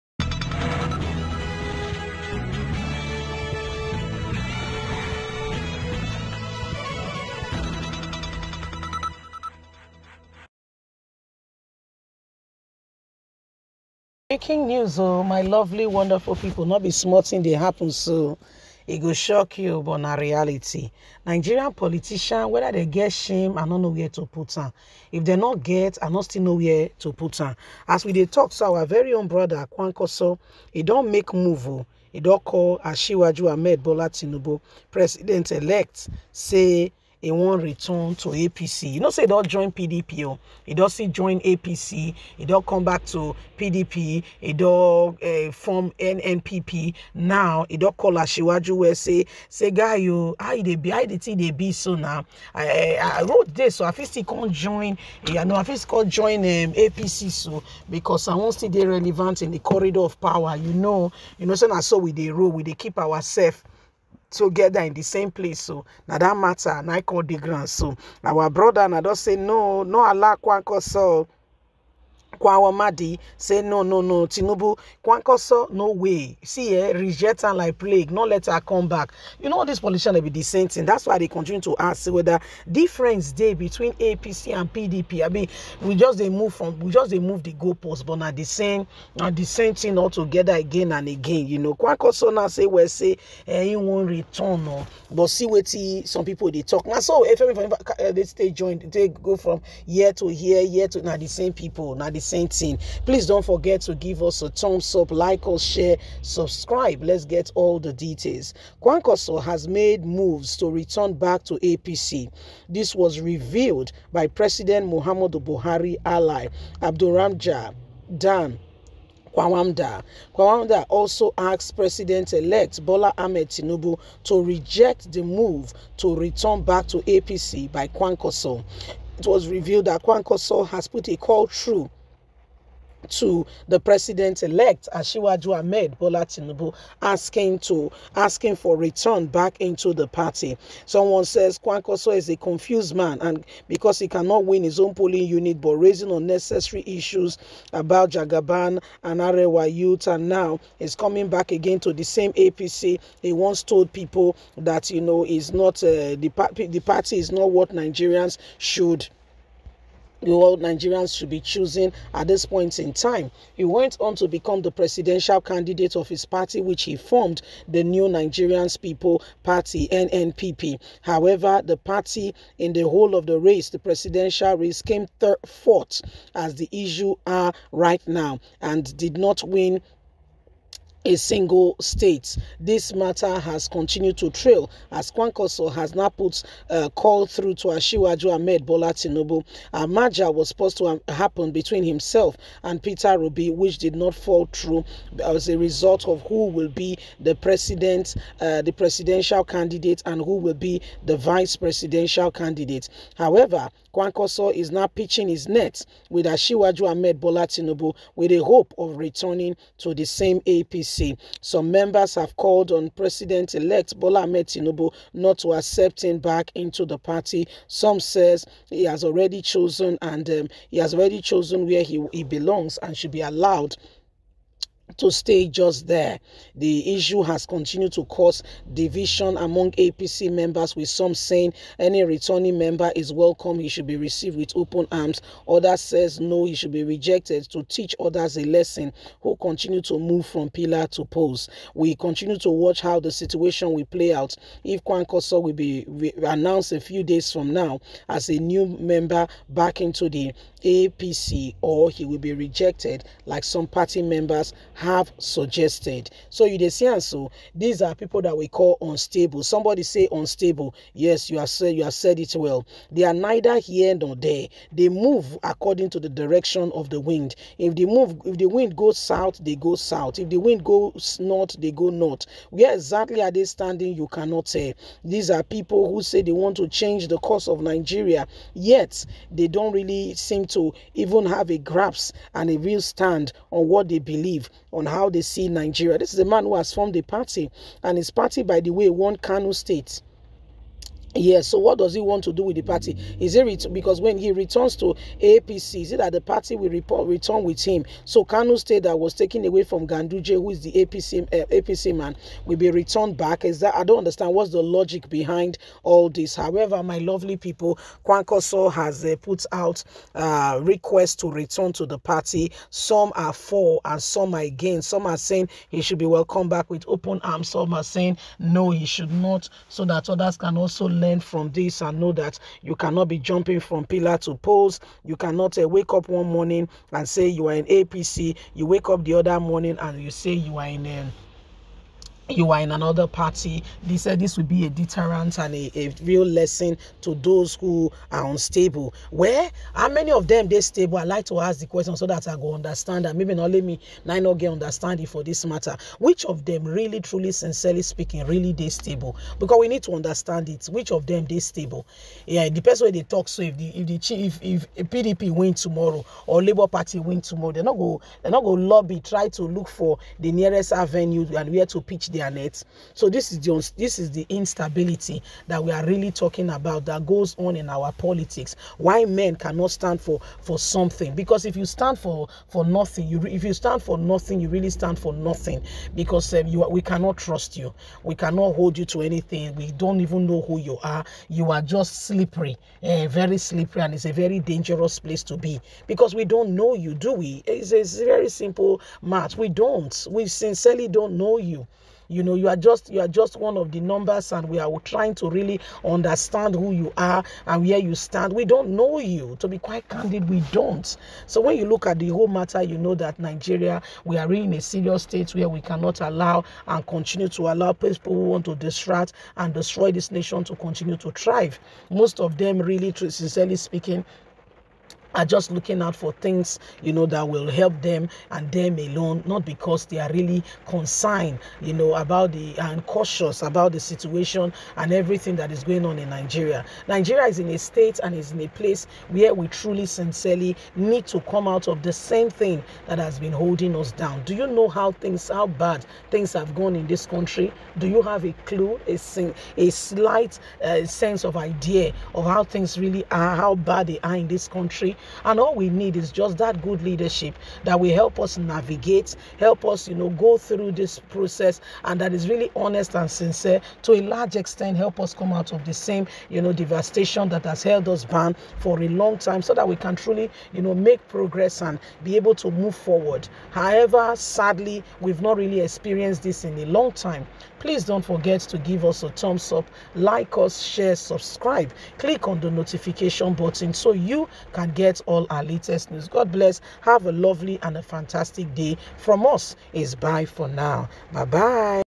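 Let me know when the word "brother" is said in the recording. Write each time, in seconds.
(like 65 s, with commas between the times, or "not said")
29 s, 68 s.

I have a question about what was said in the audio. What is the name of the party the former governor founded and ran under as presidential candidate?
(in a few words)
New Nigerians People Party.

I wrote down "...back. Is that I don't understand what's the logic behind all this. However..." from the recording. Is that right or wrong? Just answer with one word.
right.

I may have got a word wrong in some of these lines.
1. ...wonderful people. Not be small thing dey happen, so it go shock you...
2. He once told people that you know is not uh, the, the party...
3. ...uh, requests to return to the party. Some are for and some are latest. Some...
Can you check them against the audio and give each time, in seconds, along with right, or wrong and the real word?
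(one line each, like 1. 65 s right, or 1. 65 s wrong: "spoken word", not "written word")
1. 15 s right
2. 153 s right
3. 310 s wrong: "against", not "latest".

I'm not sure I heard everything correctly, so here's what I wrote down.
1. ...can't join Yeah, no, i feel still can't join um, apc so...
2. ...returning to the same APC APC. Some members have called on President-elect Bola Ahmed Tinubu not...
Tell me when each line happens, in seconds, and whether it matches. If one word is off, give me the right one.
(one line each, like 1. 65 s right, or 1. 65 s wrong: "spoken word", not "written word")
1. 54 s right
2. 208 s right.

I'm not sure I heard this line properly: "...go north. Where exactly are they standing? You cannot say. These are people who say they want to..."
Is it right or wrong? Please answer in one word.
right.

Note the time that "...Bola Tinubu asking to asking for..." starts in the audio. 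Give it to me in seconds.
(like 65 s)
135 s.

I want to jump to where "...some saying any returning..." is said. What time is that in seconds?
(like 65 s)
230 s.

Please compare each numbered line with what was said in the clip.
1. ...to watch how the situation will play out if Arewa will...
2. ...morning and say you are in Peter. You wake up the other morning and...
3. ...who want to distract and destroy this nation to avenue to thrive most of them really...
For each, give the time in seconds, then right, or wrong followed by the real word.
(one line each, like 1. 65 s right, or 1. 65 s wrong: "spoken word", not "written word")
1. 242 s wrong: "Kwankwaso", not "Arewa"
2. 326 s wrong: "APC", not "Peter"
3. 408 s wrong: "continue", not "avenue".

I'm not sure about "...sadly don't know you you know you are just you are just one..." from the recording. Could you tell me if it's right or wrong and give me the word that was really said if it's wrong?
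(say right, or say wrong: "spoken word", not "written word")
wrong: "sincerely", not "sadly".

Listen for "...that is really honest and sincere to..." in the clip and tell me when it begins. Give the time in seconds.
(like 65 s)
452 s.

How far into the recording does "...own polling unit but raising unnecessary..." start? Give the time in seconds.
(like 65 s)
144 s.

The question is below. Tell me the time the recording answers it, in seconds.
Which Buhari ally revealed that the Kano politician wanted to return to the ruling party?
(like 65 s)
116 s.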